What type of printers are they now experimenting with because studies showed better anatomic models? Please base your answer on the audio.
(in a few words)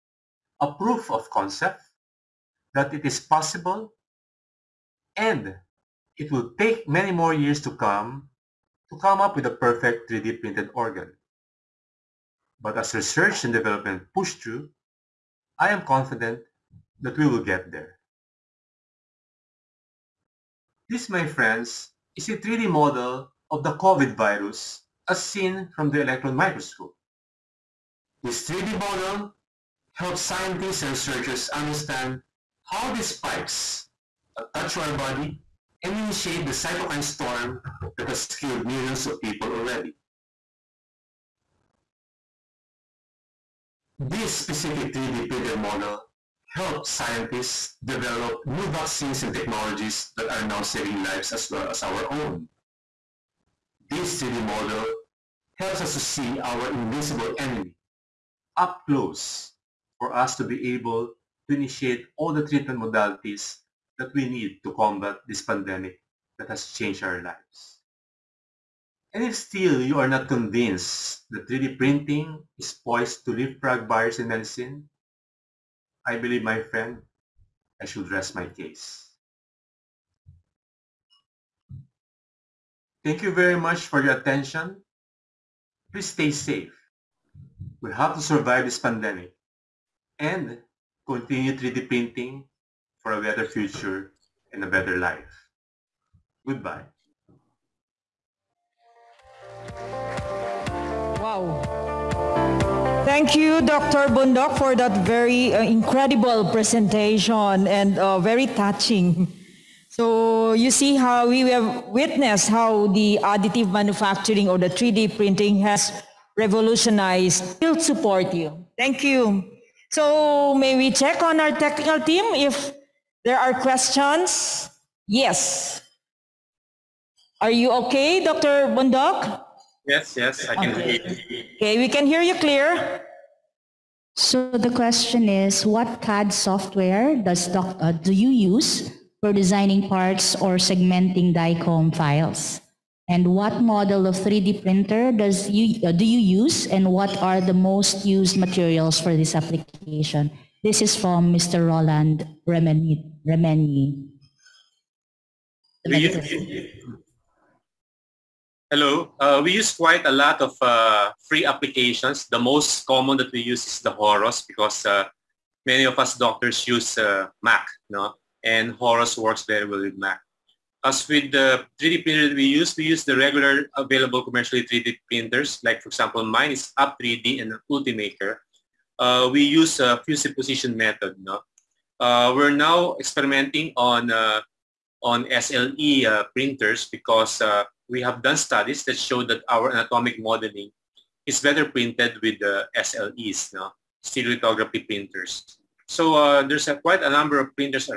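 SLA printers.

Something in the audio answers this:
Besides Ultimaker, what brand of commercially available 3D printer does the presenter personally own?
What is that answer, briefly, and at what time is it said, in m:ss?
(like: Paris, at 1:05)
Up3D, at 2:56.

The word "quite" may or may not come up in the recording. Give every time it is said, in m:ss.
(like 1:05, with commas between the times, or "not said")
2:39, 3:16.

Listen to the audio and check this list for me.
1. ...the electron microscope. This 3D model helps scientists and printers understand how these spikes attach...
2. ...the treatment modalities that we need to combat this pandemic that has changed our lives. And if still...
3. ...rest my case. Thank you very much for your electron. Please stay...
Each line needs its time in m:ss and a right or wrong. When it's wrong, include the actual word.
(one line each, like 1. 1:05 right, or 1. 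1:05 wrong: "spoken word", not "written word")
1. 0:25 wrong: "researchers", not "printers"
2. 1:02 right
3. 1:18 wrong: "attention", not "electron".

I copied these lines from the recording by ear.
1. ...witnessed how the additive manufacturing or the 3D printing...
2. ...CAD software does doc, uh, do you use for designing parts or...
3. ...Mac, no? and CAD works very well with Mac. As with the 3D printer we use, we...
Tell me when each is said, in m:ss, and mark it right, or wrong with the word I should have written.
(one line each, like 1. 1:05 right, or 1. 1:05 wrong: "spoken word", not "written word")
1. 1:51 right
2. 2:16 right
3. 2:47 wrong: "Horos", not "CAD".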